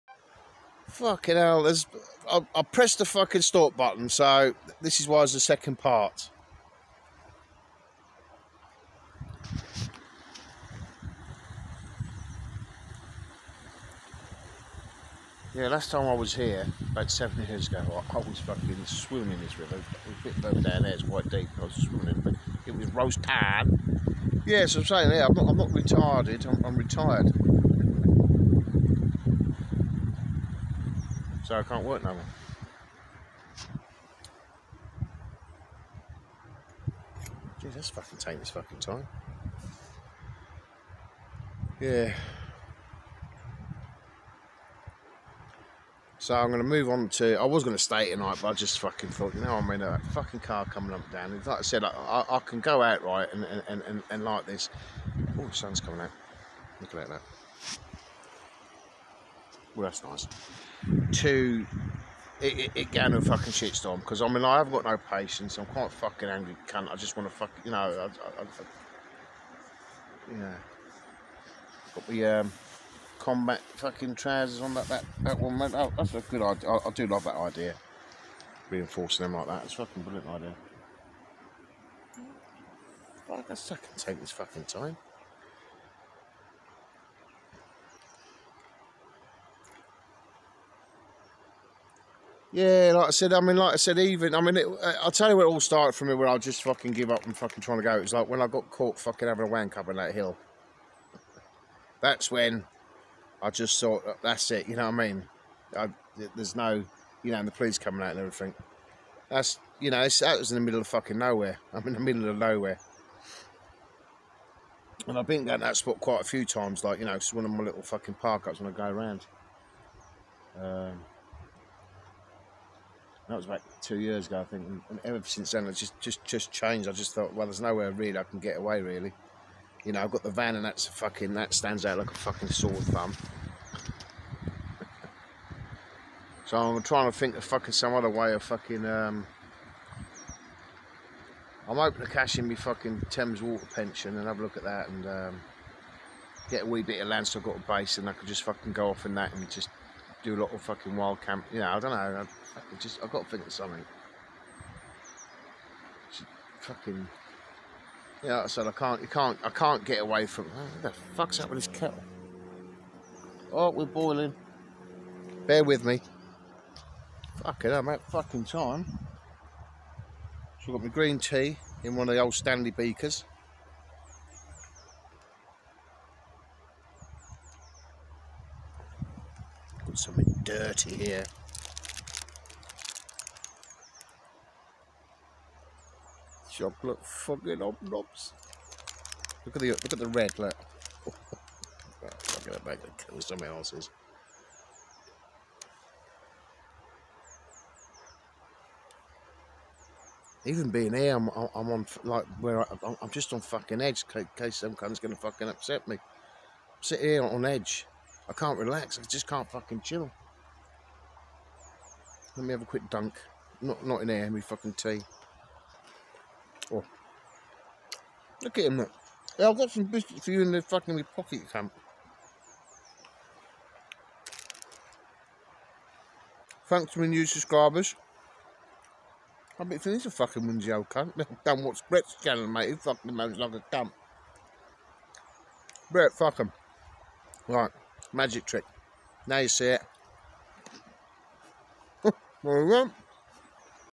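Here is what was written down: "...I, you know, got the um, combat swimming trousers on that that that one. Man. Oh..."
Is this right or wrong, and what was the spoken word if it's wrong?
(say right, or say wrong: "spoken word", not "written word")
wrong: "fucking", not "swimming".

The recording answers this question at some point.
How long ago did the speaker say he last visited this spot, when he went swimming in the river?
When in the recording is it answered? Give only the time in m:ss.
0:17.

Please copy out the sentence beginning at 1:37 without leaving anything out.
It was like when I got caught fucking having a wank up on that hill.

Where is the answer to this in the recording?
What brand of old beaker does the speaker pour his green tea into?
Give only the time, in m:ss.
2:52.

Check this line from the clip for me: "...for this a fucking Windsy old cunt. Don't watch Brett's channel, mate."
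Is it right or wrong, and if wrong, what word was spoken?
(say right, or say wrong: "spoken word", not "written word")
right.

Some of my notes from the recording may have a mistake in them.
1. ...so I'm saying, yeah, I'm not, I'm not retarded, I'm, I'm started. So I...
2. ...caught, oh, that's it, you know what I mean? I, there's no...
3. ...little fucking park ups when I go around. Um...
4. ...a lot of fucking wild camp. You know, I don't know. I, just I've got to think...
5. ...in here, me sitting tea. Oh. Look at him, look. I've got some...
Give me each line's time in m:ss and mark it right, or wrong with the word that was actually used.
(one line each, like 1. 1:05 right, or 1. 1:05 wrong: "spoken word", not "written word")
1. 0:24 wrong: "retired", not "started"
2. 1:43 wrong: "thought", not "caught"
3. 1:57 right
4. 2:30 right
5. 3:34 wrong: "fucking", not "sitting".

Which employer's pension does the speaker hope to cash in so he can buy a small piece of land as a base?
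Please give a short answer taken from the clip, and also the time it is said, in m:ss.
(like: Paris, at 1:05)
Thames Water, at 2:23.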